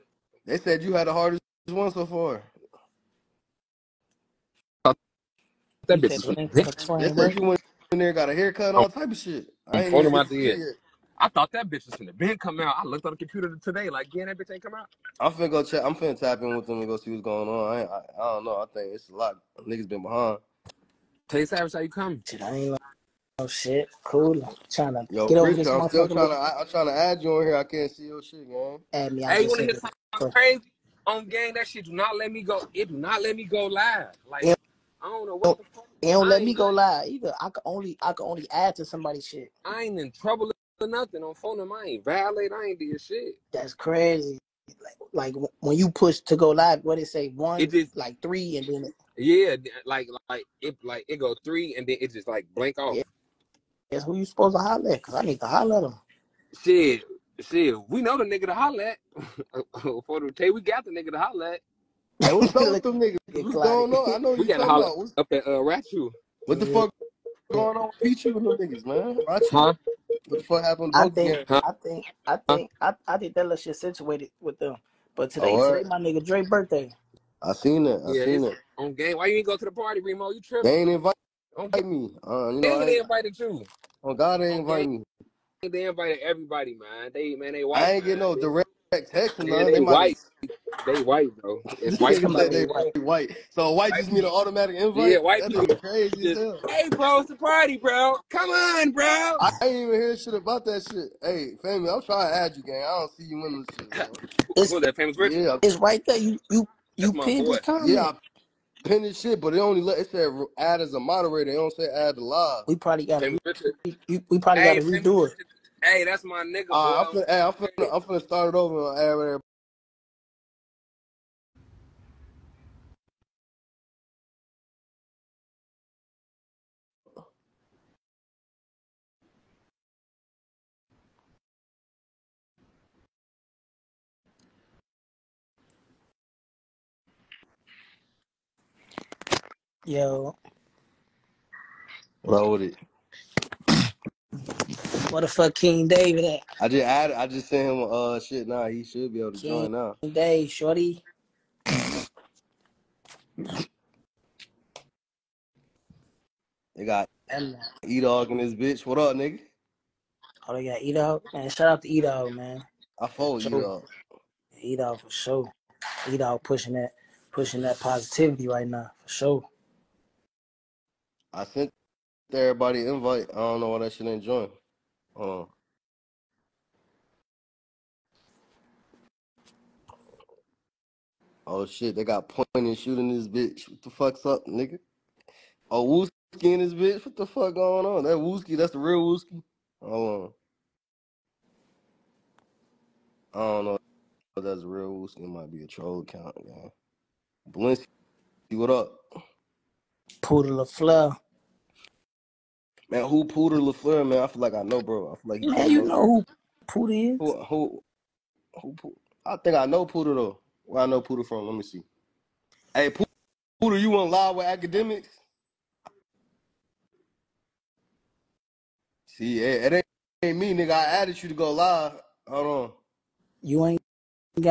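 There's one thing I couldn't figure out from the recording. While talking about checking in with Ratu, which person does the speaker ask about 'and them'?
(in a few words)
Pichu.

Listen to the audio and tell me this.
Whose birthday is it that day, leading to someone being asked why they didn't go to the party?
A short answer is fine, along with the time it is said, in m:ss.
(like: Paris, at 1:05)
Drake, at 1:16.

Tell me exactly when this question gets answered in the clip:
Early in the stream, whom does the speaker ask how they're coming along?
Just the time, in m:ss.
0:21.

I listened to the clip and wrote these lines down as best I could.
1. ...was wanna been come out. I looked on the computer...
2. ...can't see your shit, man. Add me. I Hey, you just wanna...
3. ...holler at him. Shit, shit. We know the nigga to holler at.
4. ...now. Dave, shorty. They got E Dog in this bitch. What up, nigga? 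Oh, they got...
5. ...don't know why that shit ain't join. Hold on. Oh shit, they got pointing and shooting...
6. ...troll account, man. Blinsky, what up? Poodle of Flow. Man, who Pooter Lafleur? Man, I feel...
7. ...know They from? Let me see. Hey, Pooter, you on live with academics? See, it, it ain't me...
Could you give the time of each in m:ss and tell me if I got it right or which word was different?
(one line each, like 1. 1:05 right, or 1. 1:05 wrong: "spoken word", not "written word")
1. 0:11 wrong: "gonna", not "wanna"
2. 0:27 right
3. 0:55 right
4. 2:29 right
5. 2:53 right
6. 3:15 right
7. 3:30 wrong: "Pooter", not "They".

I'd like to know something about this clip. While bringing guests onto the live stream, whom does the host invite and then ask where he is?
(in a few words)
King David.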